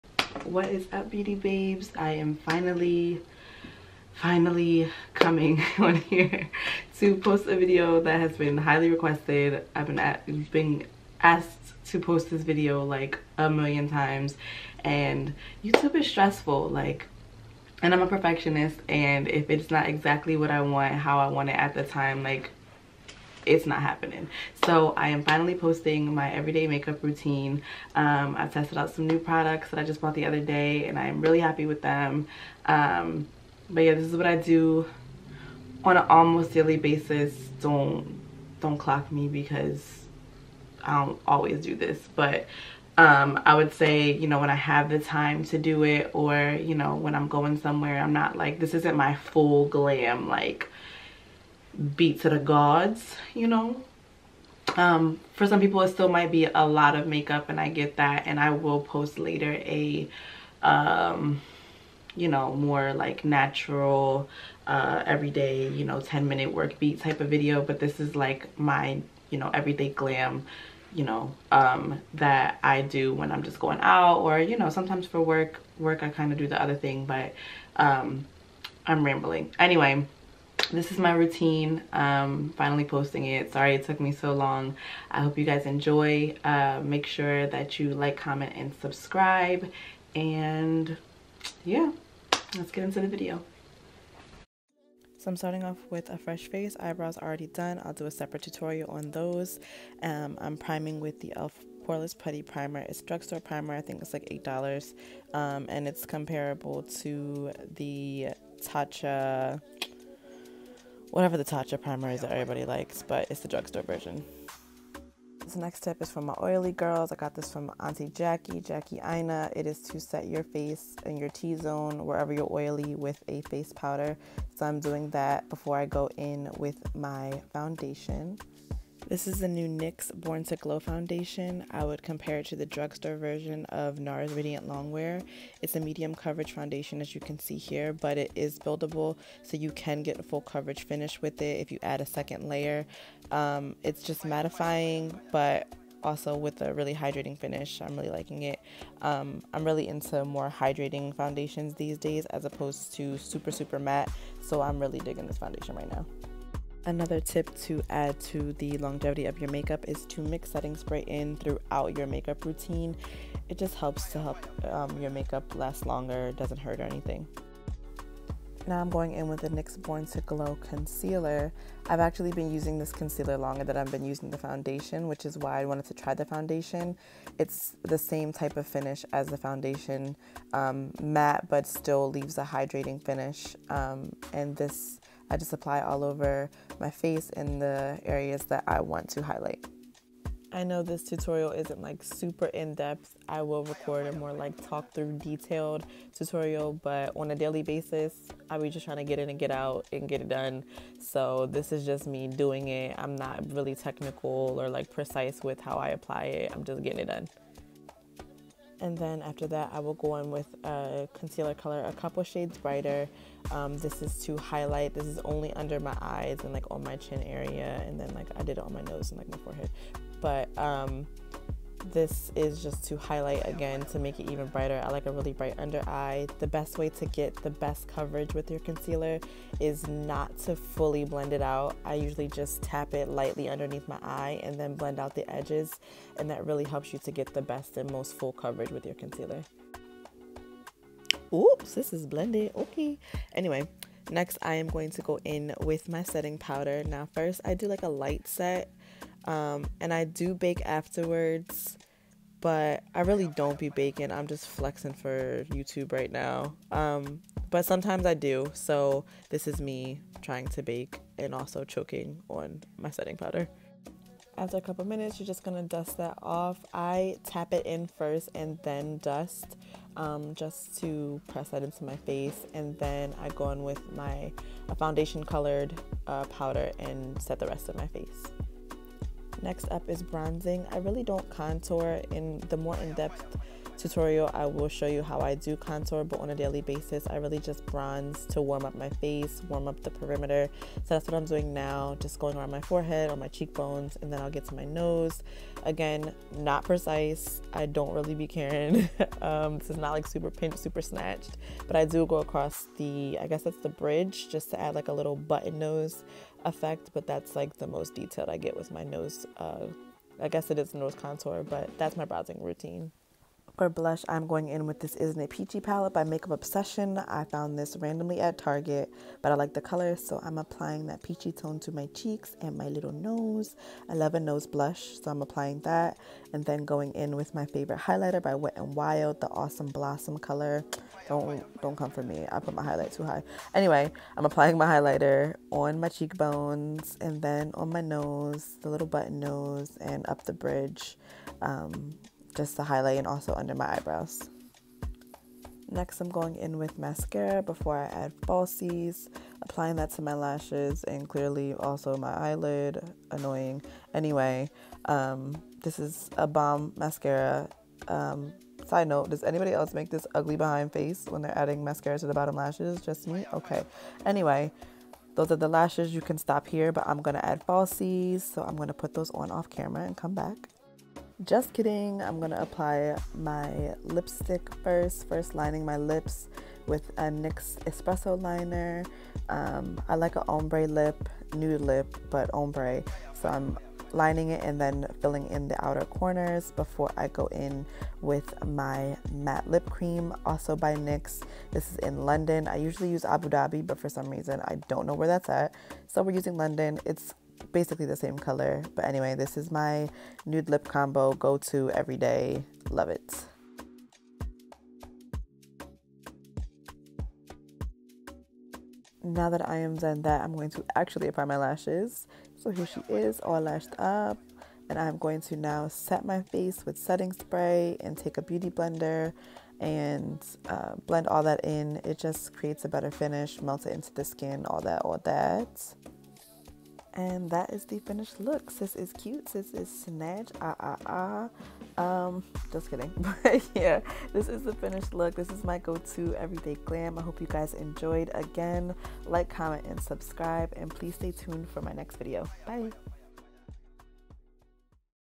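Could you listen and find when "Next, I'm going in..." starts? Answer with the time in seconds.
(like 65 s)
345 s.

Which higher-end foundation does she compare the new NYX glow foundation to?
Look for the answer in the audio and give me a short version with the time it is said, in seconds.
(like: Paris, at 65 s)
NARS Radiant Longwear, at 133 s.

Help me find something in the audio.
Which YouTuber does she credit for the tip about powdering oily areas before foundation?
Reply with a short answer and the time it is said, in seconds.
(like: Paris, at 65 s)
Jackie Aina, at 118 s.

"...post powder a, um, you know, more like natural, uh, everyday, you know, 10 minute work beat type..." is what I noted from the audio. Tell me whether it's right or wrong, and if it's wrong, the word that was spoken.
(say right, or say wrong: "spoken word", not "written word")
wrong: "later", not "powder".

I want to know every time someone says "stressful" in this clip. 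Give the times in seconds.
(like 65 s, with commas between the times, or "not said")
16 s.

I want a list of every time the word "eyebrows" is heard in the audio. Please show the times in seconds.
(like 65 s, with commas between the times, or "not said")
96 s, 343 s.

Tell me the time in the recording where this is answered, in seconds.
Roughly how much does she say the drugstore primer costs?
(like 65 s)
104 s.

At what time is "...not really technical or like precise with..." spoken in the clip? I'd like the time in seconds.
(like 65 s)
203 s.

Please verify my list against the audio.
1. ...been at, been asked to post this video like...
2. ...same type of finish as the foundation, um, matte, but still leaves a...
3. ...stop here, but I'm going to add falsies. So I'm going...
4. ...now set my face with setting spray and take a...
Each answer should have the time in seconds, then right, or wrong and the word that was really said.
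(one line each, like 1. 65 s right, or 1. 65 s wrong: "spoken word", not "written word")
1. 9 s right
2. 177 s right
3. 366 s right
4. 415 s right.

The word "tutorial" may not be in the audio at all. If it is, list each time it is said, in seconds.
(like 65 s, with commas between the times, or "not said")
98 s, 191 s, 196 s, 283 s.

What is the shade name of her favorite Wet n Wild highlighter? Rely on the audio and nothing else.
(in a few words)
Awesome Blossom.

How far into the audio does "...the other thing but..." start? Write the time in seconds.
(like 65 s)
76 s.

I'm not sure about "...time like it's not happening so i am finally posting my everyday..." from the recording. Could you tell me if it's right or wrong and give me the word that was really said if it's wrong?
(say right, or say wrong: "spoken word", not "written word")
right.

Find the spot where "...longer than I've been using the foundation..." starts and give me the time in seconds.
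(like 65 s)
173 s.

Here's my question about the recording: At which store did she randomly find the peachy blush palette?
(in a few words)
Target.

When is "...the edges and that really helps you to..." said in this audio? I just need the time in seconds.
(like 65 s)
235 s.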